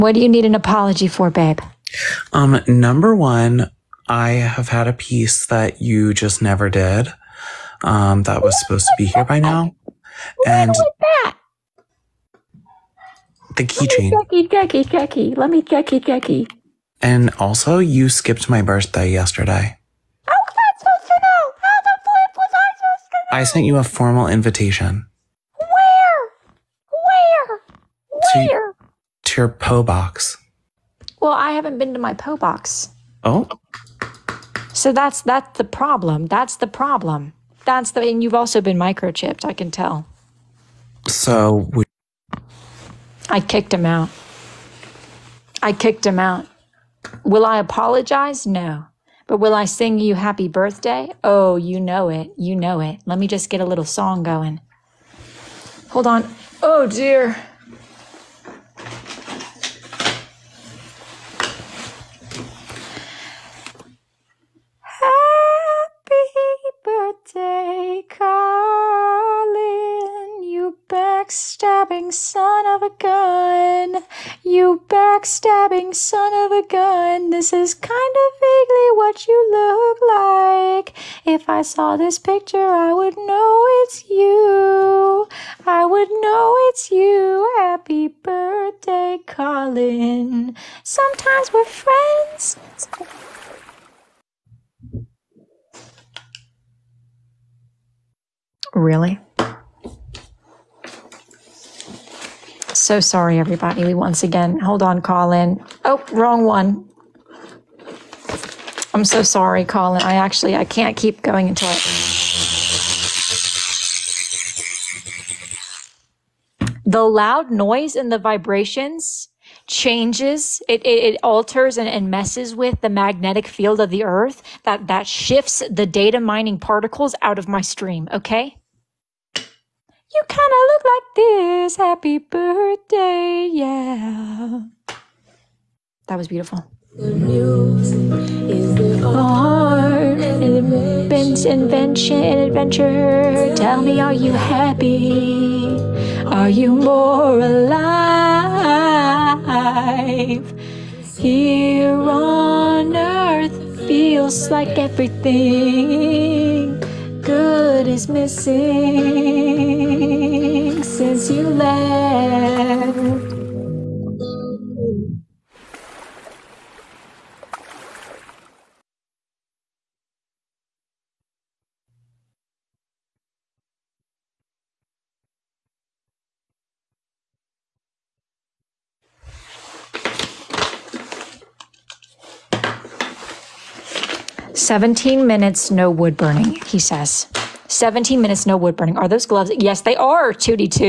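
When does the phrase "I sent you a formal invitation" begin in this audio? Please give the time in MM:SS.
00:23.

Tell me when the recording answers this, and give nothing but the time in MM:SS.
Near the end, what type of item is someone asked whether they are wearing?
03:09.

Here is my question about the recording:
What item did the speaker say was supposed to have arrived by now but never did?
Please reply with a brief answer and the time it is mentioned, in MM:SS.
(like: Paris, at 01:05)
the keychain, at 00:13.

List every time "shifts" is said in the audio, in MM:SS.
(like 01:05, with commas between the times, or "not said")
02:05.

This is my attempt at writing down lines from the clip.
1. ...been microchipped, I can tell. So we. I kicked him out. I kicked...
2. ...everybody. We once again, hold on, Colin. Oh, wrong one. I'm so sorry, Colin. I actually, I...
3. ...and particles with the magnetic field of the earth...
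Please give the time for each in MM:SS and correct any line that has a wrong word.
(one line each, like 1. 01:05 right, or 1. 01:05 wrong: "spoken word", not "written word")
1. 00:38 right
2. 01:43 right
3. 02:01 wrong: "messes", not "particles".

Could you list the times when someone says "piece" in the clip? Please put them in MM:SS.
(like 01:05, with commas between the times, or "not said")
00:04.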